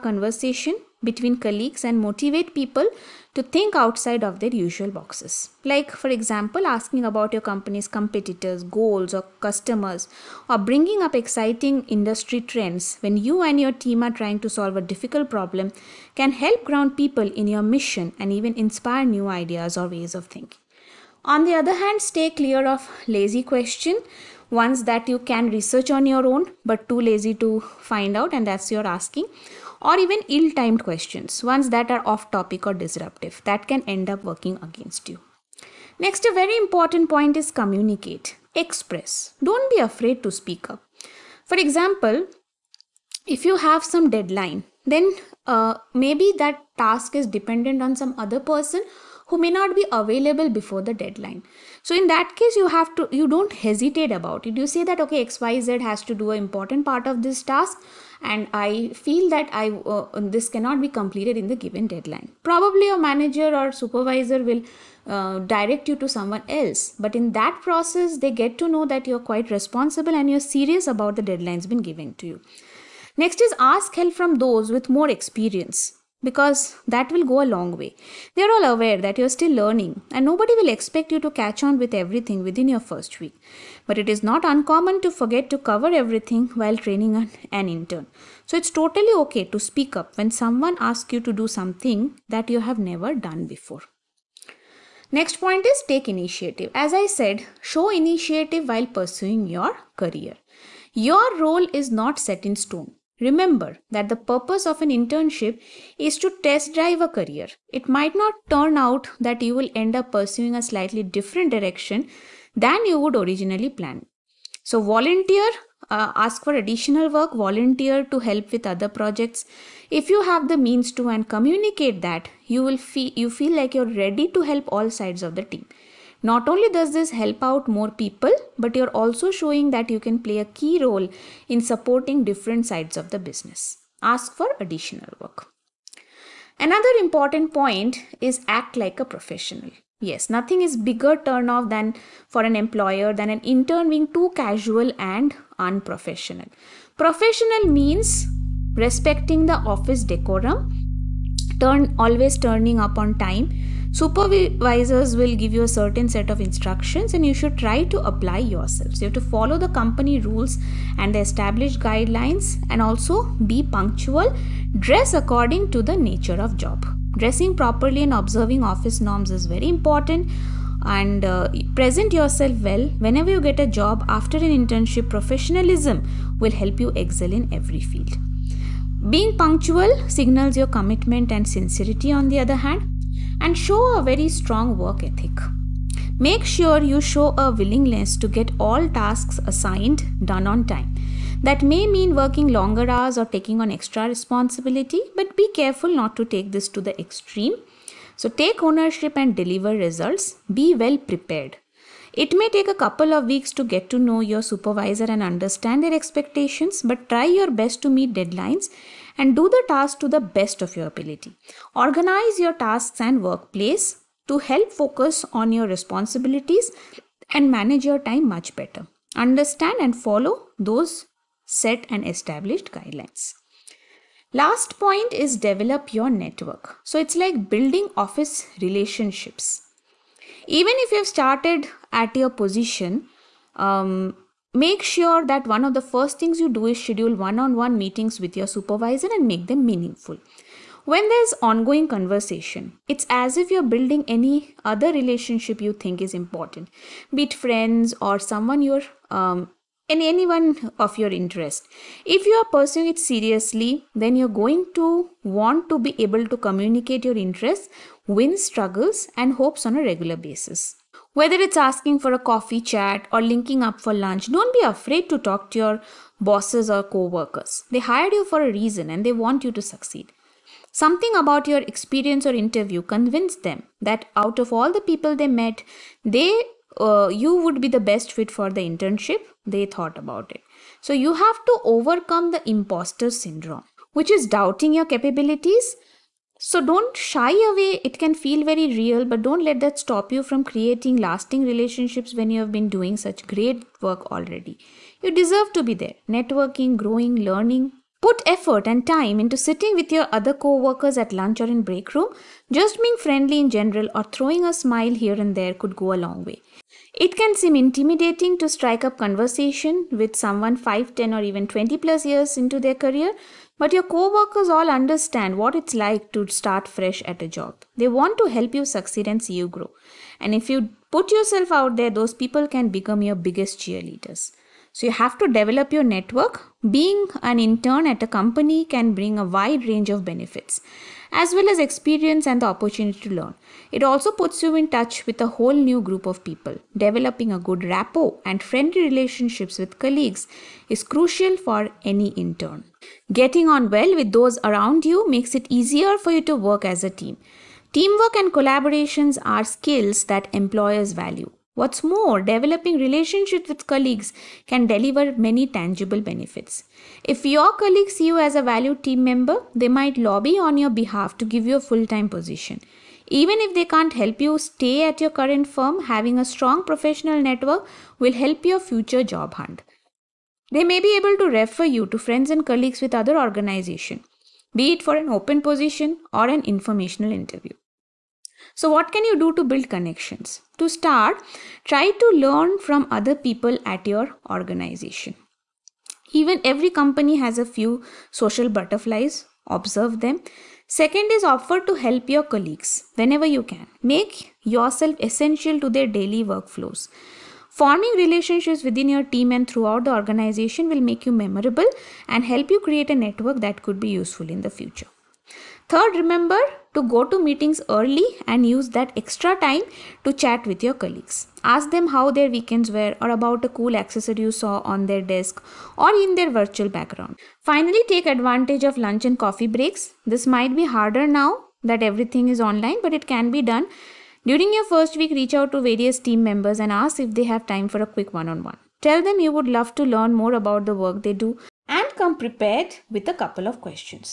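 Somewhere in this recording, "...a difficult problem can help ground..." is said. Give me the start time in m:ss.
0:14.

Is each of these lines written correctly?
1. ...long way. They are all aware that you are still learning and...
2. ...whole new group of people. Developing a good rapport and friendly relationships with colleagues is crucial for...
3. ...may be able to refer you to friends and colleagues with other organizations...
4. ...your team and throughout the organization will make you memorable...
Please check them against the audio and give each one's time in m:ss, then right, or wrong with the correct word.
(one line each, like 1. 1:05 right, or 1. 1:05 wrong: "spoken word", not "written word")
1. 1:17 right
2. 5:35 right
3. 6:10 right
4. 6:38 right.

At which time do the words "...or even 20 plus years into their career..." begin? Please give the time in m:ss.
5:11.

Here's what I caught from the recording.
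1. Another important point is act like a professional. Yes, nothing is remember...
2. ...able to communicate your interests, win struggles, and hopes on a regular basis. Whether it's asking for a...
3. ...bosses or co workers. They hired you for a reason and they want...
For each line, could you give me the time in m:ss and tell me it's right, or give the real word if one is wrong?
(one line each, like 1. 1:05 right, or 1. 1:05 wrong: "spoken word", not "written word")
1. 2:16 wrong: "bigger", not "remember"
2. 4:16 right
3. 4:26 right.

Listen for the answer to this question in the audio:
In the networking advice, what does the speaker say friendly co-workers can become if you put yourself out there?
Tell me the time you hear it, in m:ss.
5:23.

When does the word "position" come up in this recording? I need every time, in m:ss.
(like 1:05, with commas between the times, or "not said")
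3:52, 6:02, 6:15.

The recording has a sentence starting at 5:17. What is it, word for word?
They want to help you succeed and see you grow.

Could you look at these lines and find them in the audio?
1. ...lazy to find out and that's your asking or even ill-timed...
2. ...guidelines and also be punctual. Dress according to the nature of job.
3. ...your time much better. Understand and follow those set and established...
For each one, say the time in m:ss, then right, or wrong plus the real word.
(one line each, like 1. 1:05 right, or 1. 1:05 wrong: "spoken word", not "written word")
1. 0:27 right
2. 2:41 right
3. 3:37 right.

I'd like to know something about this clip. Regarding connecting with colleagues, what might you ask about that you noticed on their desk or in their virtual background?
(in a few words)
a cool accessory.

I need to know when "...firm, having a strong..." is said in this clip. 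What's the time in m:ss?
6:05.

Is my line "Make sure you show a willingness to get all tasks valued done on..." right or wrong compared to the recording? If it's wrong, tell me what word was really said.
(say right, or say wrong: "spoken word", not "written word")
wrong: "assigned", not "valued".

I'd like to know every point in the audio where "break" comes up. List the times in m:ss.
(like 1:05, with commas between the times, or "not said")
5:01, 6:59.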